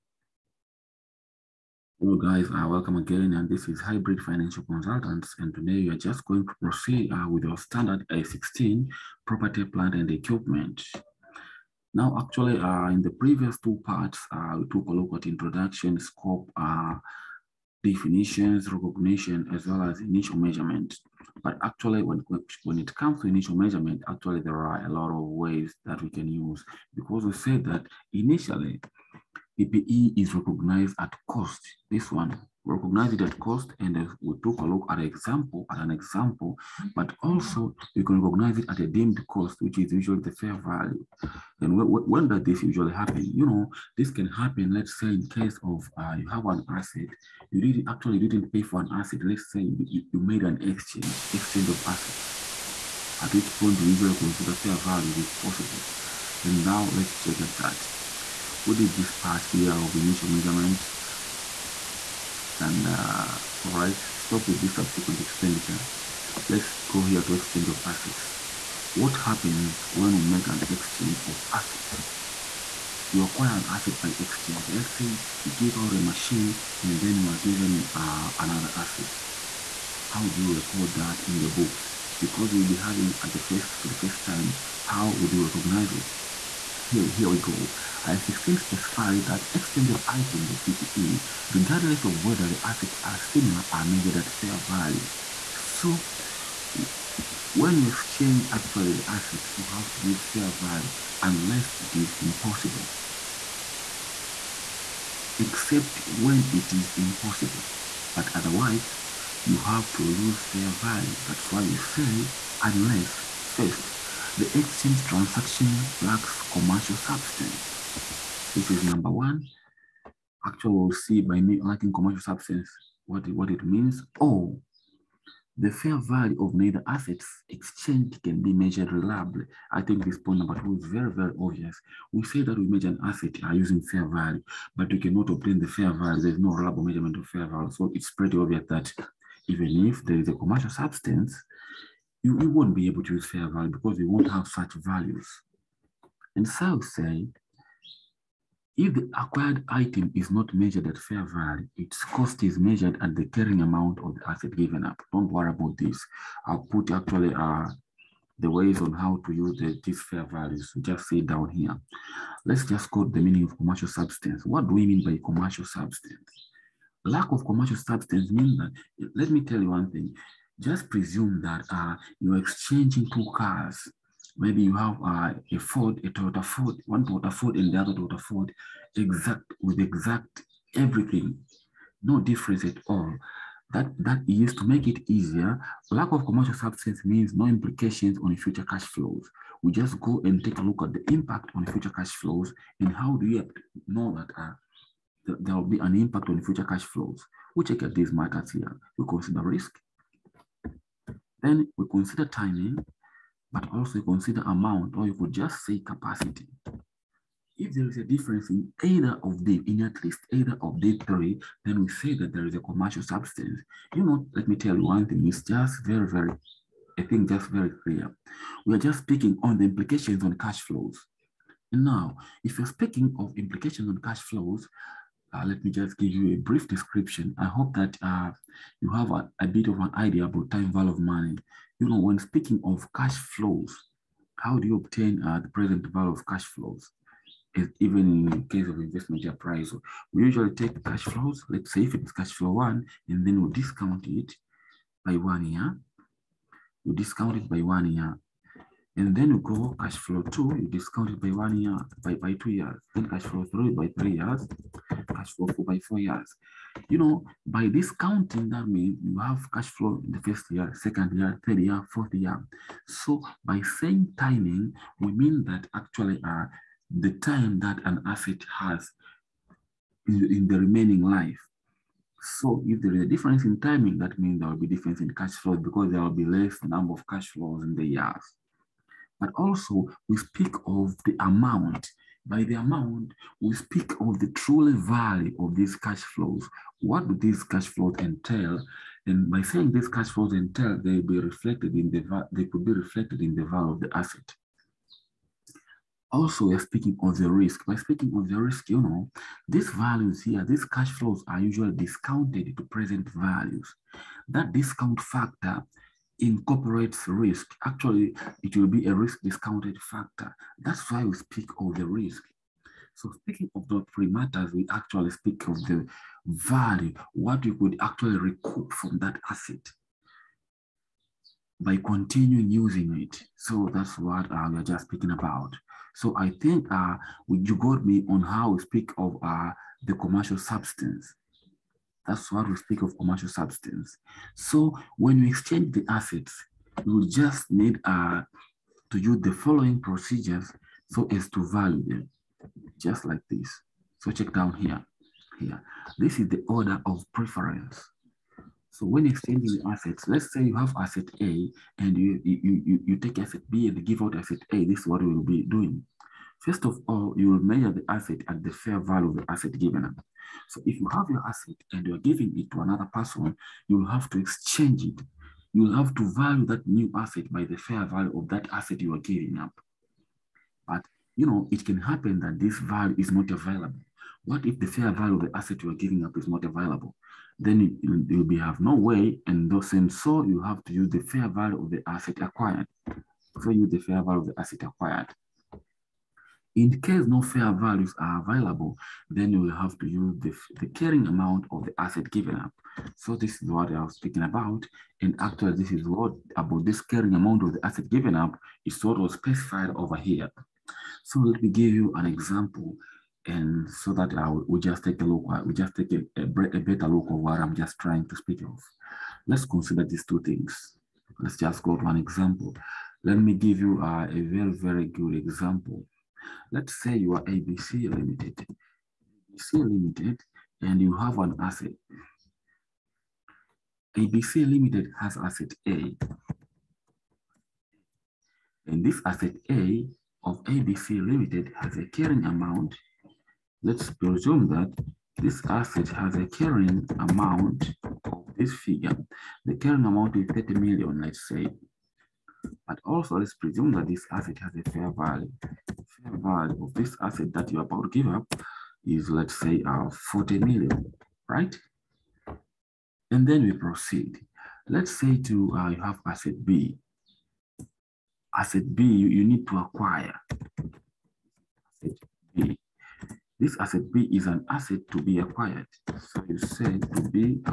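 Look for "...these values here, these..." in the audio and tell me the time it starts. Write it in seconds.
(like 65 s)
299 s.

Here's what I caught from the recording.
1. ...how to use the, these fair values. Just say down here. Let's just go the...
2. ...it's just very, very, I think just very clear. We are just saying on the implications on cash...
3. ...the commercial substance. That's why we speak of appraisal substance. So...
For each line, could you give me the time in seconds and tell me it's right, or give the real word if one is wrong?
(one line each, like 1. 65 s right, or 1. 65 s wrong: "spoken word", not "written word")
1. 158 s right
2. 215 s wrong: "speaking", not "saying"
3. 329 s wrong: "commercial", not "appraisal".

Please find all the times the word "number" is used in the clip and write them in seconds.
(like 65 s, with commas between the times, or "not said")
118 s, 130 s, 276 s.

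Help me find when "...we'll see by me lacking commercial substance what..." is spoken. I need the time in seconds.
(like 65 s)
120 s.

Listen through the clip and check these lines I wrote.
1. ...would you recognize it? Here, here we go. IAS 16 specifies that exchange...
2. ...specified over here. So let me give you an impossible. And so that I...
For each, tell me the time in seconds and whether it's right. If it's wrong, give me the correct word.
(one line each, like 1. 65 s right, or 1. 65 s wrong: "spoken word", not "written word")
1. 85 s right
2. 399 s wrong: "example", not "impossible".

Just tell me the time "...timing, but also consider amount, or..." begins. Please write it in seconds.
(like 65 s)
202 s.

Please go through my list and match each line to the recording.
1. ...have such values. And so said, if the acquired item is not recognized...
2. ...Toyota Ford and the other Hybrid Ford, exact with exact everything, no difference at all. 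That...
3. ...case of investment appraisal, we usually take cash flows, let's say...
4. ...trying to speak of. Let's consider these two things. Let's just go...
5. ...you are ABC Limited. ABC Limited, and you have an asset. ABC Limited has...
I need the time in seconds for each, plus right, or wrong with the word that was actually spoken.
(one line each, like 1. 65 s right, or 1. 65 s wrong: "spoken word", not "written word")
1. 144 s wrong: "measured", not "recognized"
2. 177 s wrong: "Toyota", not "Hybrid"
3. 238 s right
4. 407 s right
5. 416 s right.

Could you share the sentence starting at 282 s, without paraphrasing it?
By the amount, we speak of the truly value of these cash flows.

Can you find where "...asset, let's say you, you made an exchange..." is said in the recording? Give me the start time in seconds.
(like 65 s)
48 s.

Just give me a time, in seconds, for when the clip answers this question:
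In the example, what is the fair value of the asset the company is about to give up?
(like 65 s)
449 s.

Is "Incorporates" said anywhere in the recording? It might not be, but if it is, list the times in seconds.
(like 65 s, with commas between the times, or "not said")
306 s.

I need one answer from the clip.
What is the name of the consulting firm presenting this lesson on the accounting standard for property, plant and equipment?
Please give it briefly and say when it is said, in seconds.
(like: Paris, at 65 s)
Hybrid Financial Consultants, at 3 s.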